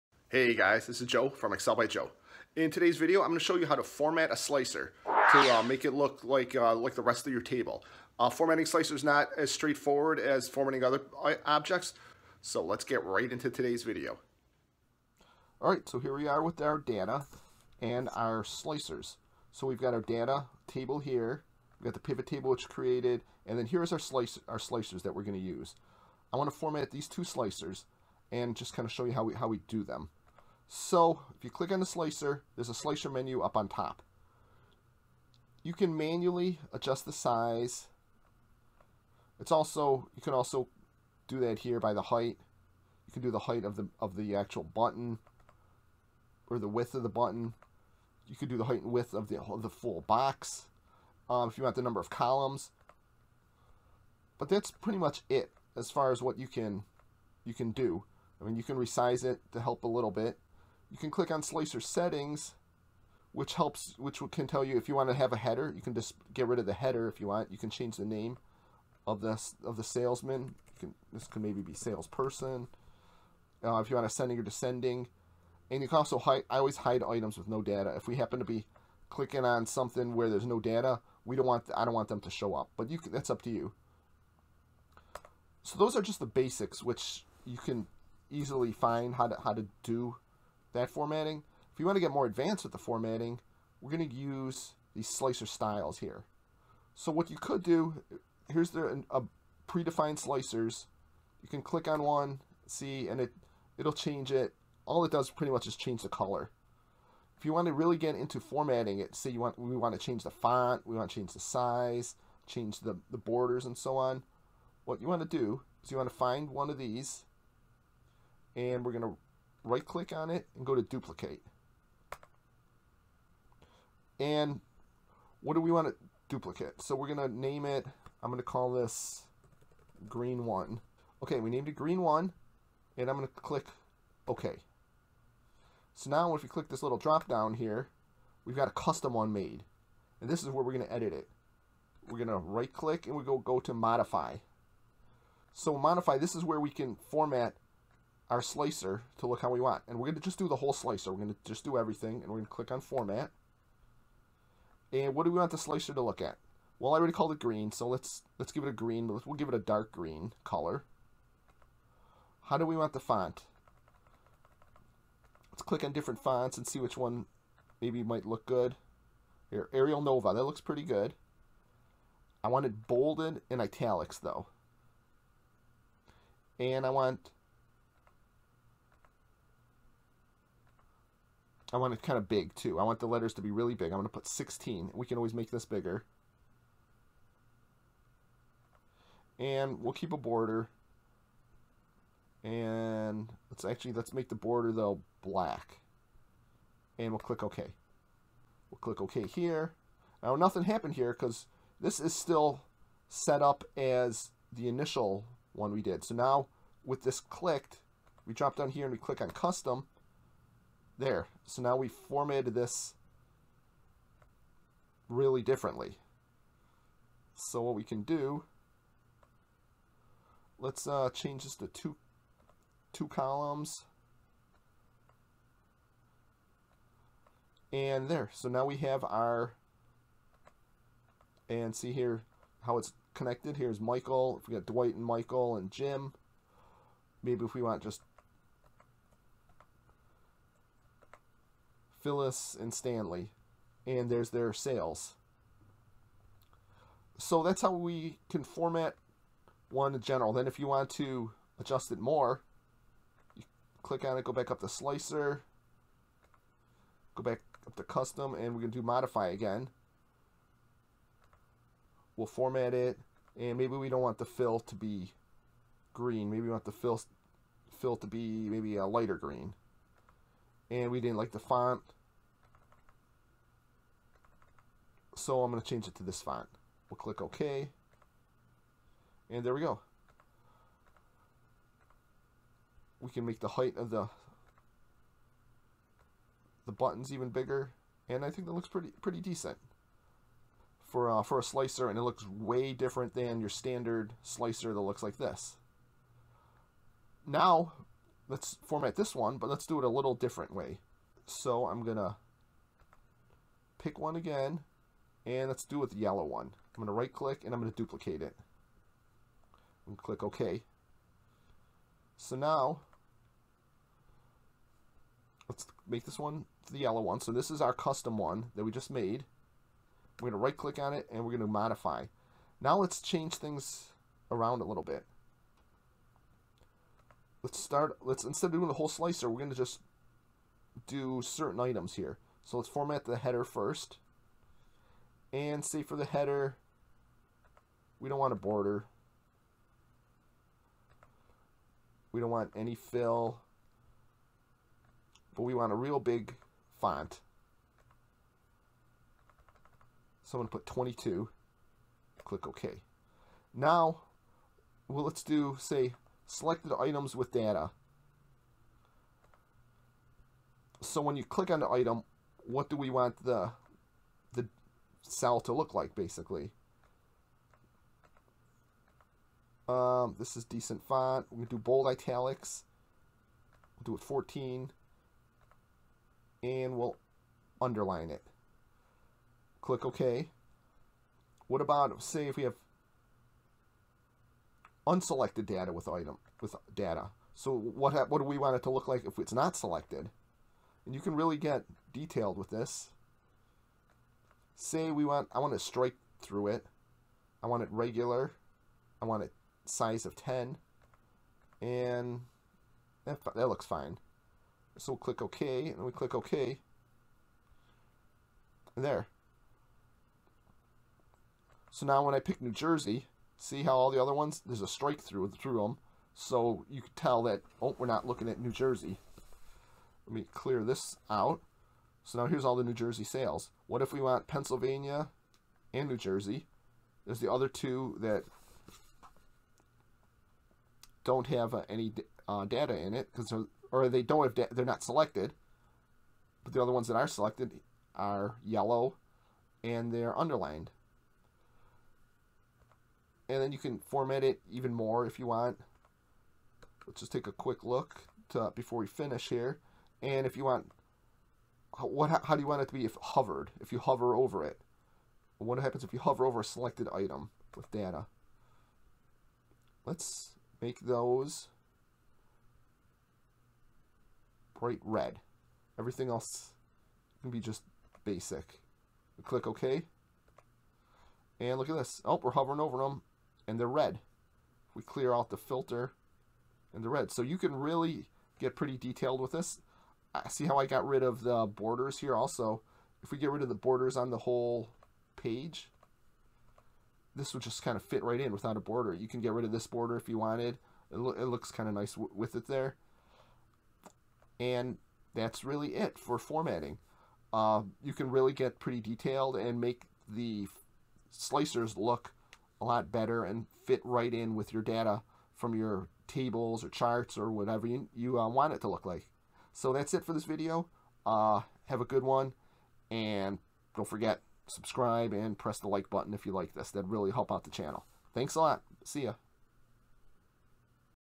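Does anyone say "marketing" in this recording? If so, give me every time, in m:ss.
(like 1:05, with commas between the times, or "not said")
not said.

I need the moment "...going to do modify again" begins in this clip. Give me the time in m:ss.
4:18.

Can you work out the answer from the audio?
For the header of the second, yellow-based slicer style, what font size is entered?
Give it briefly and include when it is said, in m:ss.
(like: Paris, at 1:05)
22, at 5:50.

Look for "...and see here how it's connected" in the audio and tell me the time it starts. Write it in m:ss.
3:51.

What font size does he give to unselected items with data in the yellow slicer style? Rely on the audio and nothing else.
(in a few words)
10.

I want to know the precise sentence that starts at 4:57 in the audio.
Now let's format this one, but let's do it a little different way.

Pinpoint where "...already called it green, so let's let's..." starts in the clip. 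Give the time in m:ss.
2:36.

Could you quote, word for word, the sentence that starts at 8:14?
And that's really it for formatting.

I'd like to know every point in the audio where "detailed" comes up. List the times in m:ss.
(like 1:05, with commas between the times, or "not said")
6:31, 7:58, 8:18.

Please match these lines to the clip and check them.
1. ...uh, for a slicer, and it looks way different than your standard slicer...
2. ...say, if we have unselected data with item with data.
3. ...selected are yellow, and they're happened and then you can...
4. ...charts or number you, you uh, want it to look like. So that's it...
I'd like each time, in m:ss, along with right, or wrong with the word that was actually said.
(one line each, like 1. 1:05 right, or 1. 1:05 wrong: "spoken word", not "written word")
1. 4:51 right
2. 6:22 right
3. 7:17 wrong: "underlined", not "happened"
4. 8:26 wrong: "whatever", not "number".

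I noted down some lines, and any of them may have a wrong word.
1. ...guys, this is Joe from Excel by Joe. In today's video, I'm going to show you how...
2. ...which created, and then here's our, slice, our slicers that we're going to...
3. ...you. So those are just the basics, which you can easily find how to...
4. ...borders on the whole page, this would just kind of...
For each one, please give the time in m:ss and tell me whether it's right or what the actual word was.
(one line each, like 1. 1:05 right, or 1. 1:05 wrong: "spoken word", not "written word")
1. 0:00 right
2. 0:22 right
3. 1:23 right
4. 8:03 right.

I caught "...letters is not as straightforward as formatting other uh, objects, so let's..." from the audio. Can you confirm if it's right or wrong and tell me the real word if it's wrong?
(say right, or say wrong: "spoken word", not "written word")
wrong: "slicers", not "letters".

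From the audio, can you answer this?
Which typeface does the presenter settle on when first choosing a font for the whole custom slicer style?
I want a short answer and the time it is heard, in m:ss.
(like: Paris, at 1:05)
Arial Nova, at 2:49.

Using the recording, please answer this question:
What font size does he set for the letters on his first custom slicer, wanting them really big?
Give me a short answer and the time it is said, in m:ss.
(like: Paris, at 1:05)
16, at 3:04.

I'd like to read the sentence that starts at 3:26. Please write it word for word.
So now with this clicked, we drop down here and we click on custom there.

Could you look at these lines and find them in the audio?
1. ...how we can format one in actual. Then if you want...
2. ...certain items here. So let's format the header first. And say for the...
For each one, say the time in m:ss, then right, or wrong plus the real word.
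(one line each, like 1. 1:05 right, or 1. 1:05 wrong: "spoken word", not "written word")
1. 4:07 wrong: "general", not "actual"
2. 5:31 right.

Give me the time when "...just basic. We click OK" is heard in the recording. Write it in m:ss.
7:47.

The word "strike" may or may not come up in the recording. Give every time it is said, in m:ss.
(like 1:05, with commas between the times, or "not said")
6:35, 6:54.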